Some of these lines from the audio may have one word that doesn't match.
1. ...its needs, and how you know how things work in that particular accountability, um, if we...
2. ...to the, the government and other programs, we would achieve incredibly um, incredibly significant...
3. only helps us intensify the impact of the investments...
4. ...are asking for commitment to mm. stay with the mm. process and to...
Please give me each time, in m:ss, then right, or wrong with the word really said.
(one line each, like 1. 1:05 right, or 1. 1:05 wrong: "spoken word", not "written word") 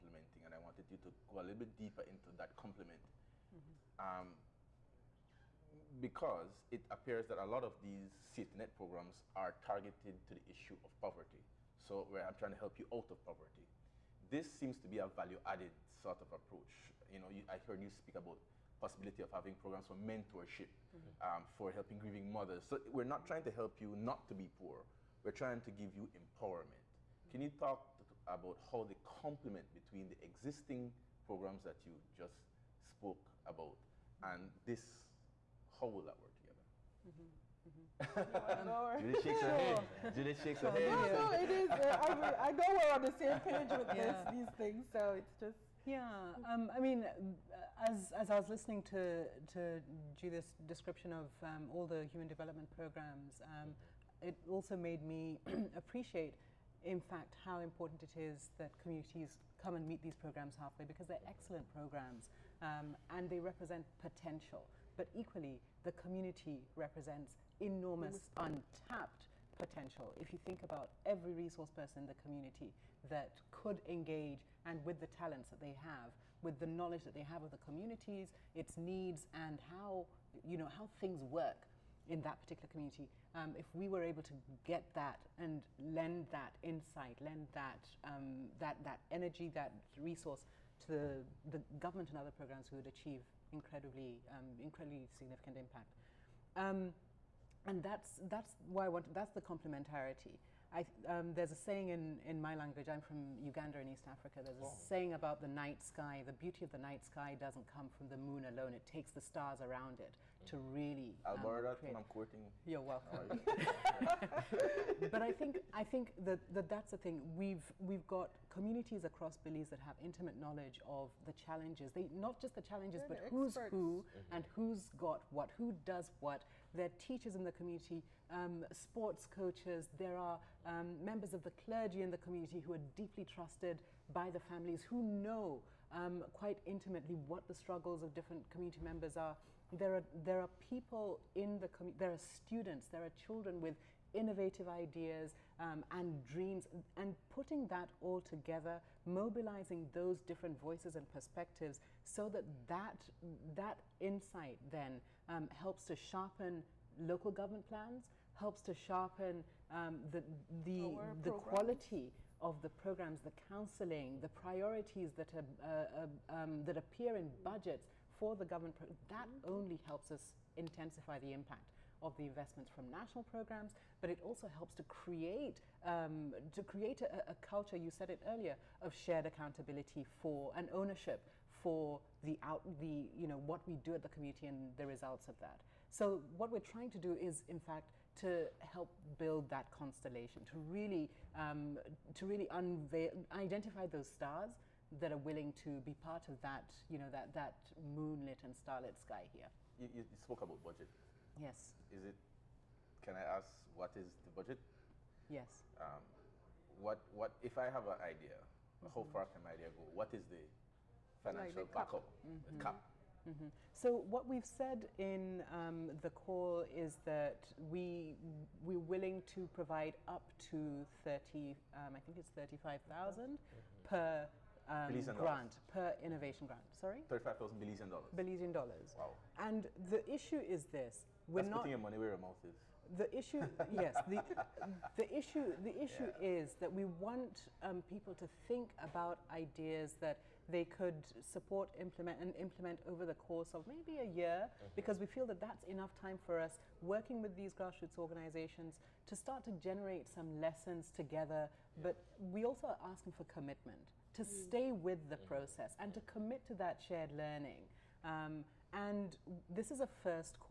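1. 1:18 wrong: "community", not "accountability"
2. 1:30 right
3. 2:49 right
4. 4:12 right.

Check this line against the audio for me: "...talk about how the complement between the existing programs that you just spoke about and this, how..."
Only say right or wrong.
right.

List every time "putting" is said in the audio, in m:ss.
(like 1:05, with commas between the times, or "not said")
2:27, 3:51.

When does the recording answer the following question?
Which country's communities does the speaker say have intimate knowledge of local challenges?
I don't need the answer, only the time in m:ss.
1:59.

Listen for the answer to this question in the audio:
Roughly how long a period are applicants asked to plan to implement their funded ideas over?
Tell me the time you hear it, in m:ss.
4:03.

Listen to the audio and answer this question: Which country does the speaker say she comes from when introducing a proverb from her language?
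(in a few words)
Uganda.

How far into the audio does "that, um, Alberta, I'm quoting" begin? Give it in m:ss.
1:51.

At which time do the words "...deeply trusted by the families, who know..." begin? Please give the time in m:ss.
2:12.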